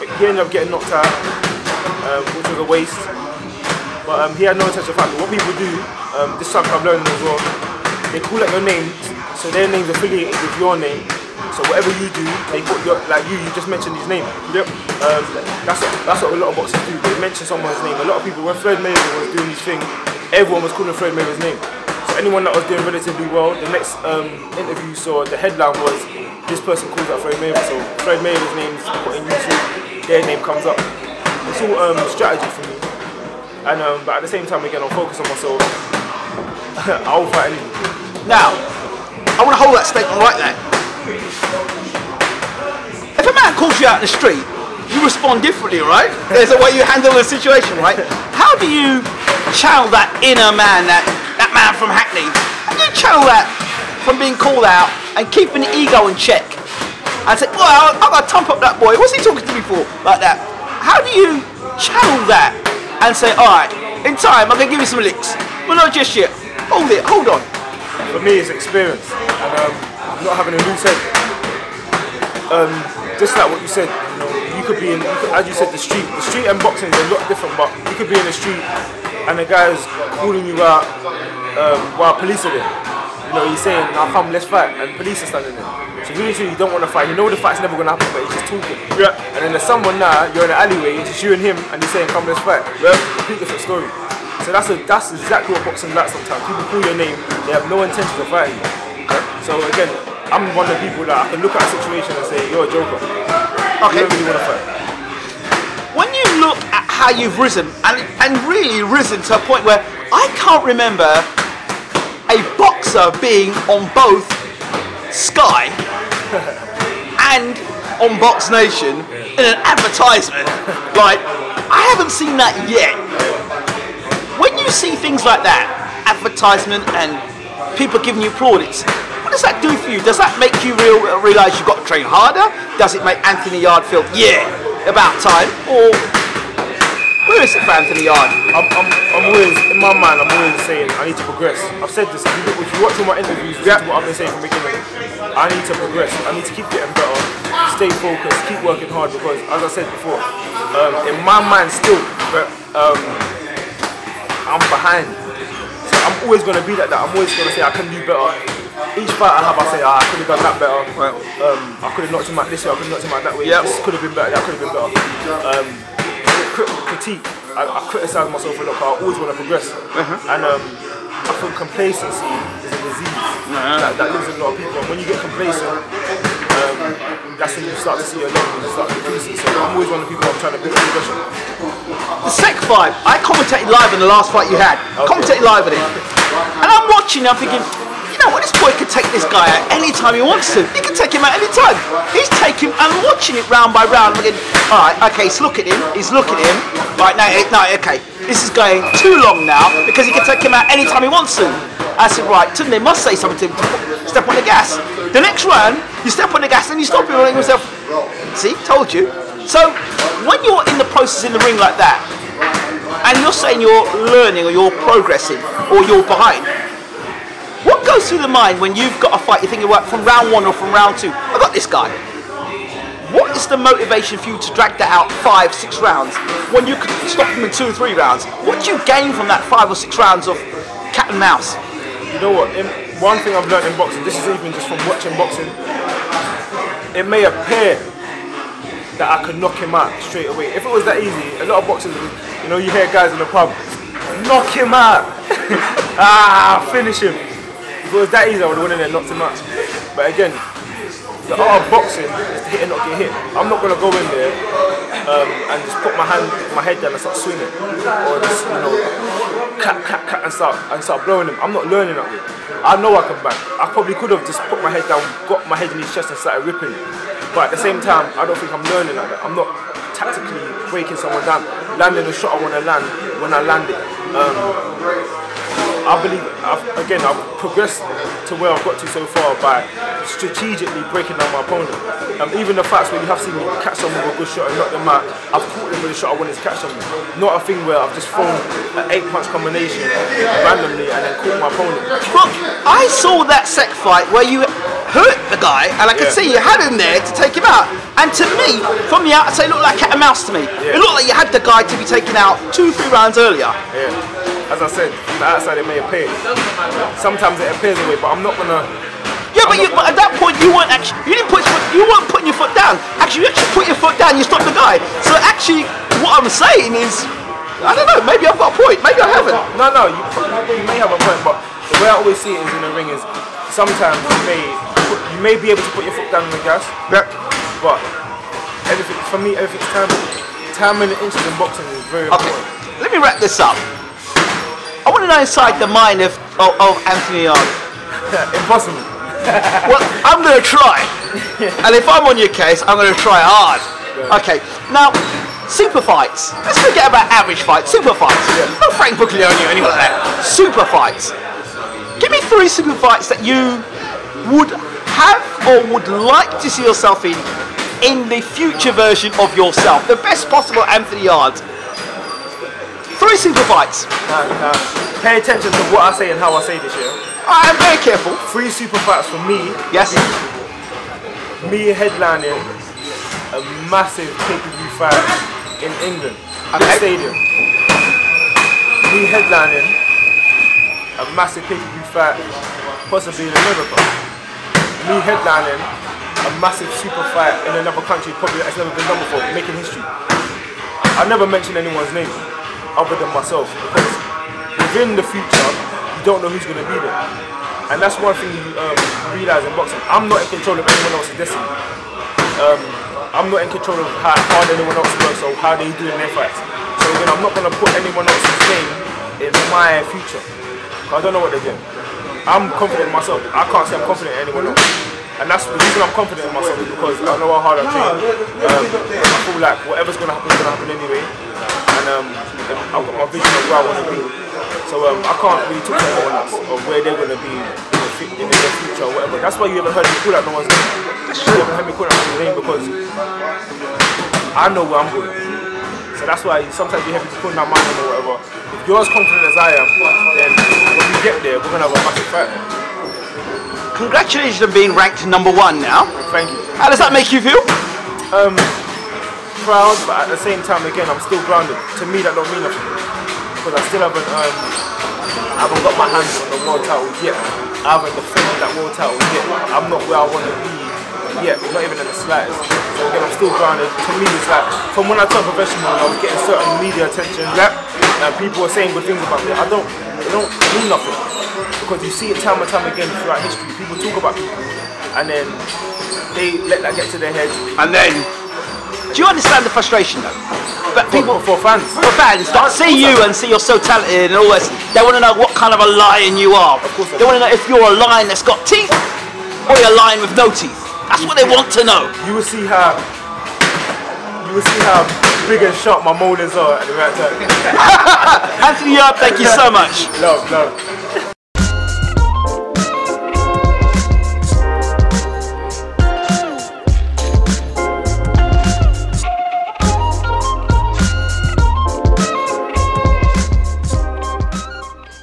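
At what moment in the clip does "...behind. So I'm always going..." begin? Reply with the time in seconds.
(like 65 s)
154 s.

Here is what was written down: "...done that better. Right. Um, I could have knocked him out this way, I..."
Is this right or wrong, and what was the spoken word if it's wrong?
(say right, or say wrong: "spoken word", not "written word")
right.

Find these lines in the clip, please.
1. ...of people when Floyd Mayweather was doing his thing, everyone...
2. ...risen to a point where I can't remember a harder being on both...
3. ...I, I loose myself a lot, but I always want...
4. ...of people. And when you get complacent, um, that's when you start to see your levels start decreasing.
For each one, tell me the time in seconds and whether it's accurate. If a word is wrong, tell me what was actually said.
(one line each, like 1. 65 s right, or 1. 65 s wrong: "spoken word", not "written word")
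1. 18 s right
2. 108 s wrong: "boxer", not "harder"
3. 167 s wrong: "criticise", not "loose"
4. 174 s right.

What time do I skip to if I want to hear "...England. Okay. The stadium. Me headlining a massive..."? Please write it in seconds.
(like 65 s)
375 s.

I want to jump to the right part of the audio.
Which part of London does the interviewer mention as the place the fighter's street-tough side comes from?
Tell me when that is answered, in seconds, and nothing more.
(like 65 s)
51 s.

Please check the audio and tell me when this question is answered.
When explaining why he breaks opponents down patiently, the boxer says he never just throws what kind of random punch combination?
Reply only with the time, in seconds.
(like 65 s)
288 s.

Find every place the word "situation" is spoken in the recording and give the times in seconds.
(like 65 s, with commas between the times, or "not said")
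47 s, 101 s.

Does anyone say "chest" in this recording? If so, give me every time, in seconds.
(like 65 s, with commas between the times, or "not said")
265 s.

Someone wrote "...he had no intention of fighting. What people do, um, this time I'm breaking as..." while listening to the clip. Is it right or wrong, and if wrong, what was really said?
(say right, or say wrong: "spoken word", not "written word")
wrong: "learning", not "breaking".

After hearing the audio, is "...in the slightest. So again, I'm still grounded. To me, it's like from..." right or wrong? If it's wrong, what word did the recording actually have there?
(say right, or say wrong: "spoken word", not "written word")
right.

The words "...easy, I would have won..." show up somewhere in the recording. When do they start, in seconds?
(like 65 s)
248 s.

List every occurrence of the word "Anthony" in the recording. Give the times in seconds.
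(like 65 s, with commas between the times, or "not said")
133 s, 137 s, 336 s, 360 s, 498 s.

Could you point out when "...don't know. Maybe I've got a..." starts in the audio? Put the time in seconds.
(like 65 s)
317 s.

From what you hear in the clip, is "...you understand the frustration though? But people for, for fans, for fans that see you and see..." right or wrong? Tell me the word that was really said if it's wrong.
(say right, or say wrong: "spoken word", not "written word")
right.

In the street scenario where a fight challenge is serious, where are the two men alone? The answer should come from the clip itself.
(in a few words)
an alleyway.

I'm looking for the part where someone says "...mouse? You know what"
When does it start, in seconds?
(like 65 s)
231 s.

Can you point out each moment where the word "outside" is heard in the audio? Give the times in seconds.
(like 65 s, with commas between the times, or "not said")
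299 s, 305 s.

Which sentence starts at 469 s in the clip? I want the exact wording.
I don't, it don't mean nothing because you see it time and time again throughout history.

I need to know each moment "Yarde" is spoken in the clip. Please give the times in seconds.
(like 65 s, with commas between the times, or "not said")
133 s, 138 s, 361 s, 498 s.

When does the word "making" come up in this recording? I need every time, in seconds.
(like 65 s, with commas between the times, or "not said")
389 s.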